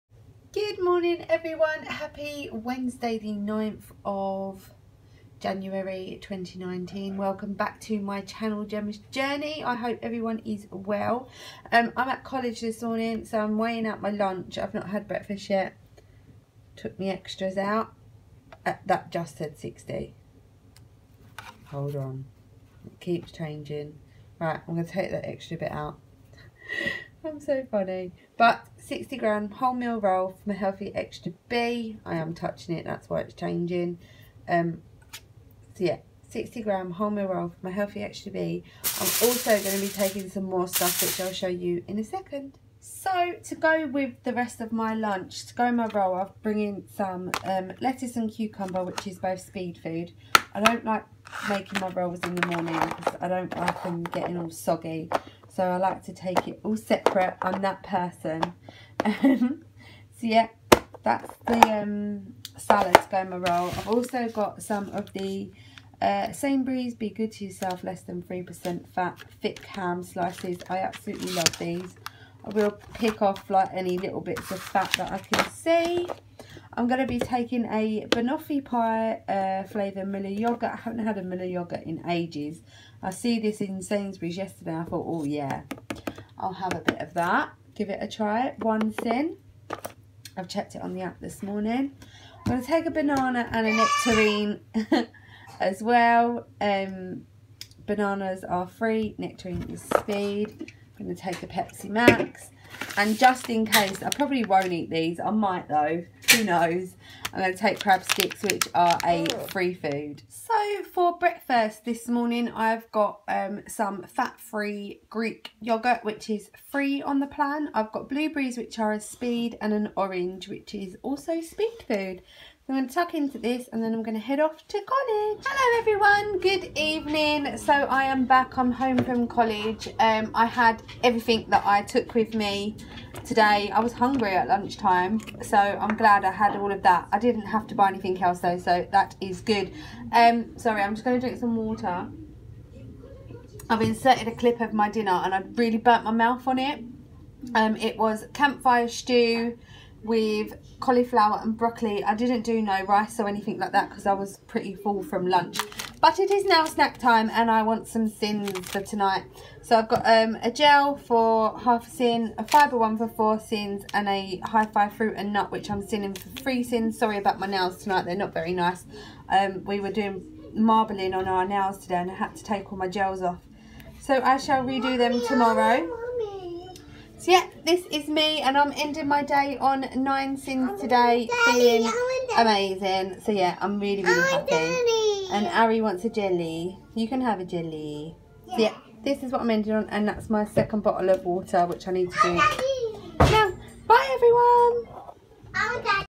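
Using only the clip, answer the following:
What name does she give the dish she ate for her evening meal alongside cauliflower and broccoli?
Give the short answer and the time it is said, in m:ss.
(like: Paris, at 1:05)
Campfire stew, at 2:28.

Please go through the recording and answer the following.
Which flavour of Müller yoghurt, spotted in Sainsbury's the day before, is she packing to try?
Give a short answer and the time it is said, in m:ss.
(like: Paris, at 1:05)
Banoffee pie, at 1:18.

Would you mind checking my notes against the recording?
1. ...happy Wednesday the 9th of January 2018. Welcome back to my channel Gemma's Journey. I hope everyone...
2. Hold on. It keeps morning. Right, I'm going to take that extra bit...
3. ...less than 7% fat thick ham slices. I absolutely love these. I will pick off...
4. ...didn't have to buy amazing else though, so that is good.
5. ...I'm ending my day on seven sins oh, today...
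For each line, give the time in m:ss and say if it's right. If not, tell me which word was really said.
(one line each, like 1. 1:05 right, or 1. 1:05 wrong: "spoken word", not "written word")
1. 0:01 wrong: "2019", not "2018"
2. 0:21 wrong: "changing", not "morning"
3. 1:07 wrong: "3", not "7"
4. 2:17 wrong: "anything", not "amazing"
5. 2:58 wrong: "nine", not "seven".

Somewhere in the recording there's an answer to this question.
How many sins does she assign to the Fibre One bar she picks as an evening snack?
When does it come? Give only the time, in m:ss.
2:43.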